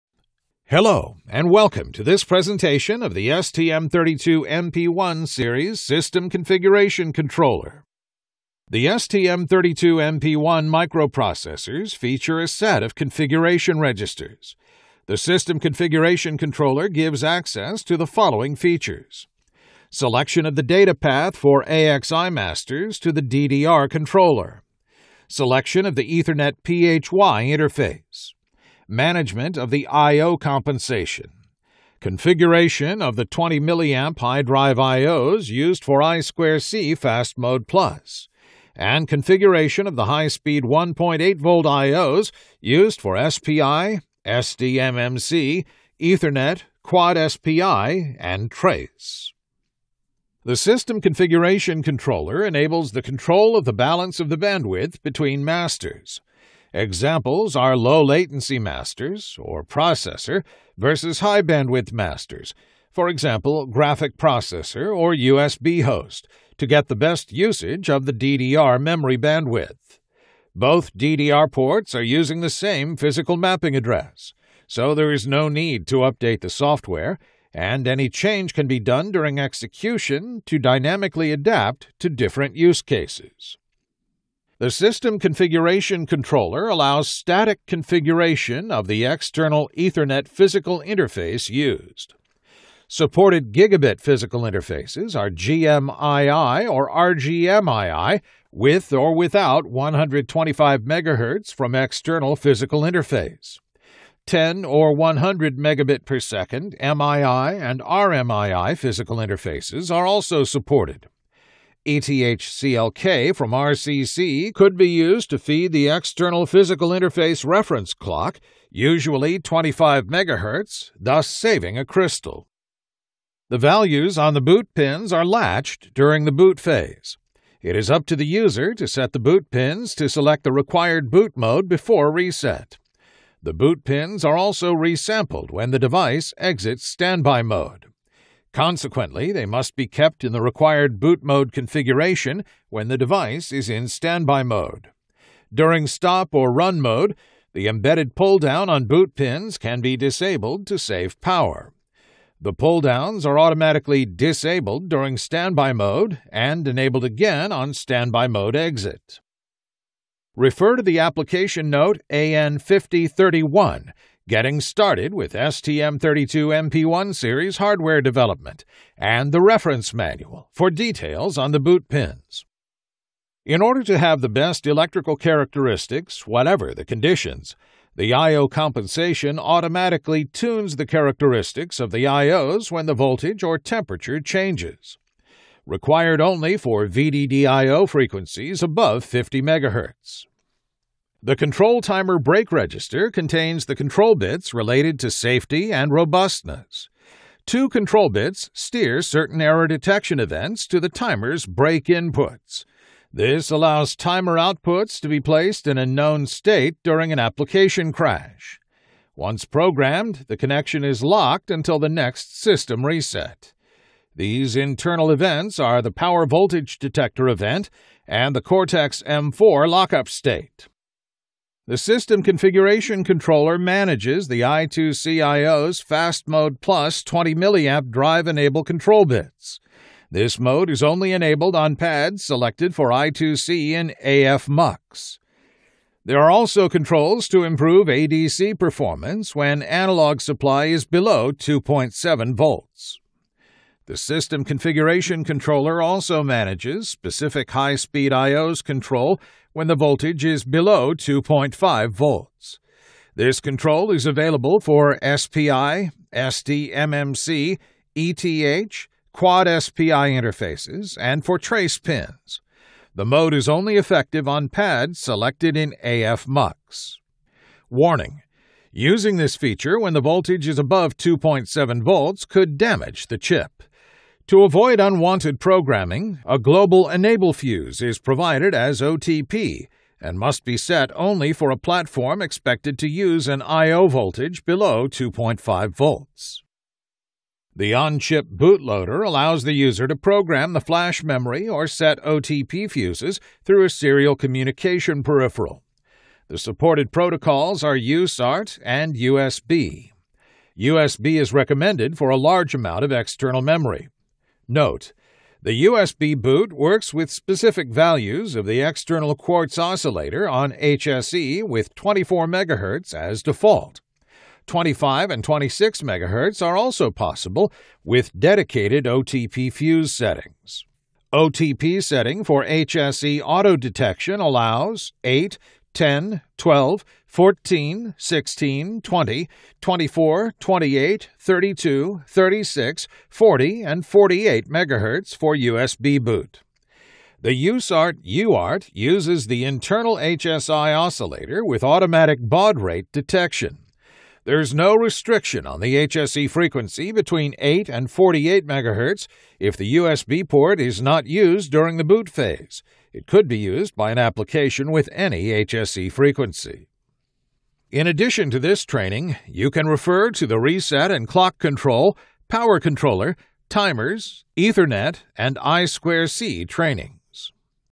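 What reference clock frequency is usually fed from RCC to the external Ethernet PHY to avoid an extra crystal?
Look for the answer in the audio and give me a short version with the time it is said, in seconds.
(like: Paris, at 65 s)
25 MHz, at 118 s.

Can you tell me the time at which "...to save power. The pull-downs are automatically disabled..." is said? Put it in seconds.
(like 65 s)
150 s.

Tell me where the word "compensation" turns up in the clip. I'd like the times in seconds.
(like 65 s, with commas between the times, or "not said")
30 s, 178 s.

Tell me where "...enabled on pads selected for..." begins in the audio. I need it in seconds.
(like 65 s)
231 s.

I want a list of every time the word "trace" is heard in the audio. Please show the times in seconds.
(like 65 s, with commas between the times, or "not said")
48 s, 261 s.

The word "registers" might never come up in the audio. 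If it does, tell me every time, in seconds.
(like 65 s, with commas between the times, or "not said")
13 s, 192 s.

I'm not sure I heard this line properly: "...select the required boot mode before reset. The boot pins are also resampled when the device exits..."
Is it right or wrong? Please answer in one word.
right.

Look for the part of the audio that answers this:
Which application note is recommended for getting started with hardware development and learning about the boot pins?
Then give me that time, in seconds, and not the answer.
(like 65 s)
162 s.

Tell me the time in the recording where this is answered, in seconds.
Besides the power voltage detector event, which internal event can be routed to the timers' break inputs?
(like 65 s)
218 s.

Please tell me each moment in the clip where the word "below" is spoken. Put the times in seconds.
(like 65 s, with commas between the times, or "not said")
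240 s, 250 s, 284 s.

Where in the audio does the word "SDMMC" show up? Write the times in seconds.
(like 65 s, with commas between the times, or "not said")
44 s, 256 s.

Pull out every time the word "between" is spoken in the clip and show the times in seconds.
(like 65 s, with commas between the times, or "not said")
55 s, 346 s.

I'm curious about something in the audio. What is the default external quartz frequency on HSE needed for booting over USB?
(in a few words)
24 MHz.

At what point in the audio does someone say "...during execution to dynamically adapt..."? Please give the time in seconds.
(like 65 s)
79 s.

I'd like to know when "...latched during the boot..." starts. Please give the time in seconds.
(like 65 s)
125 s.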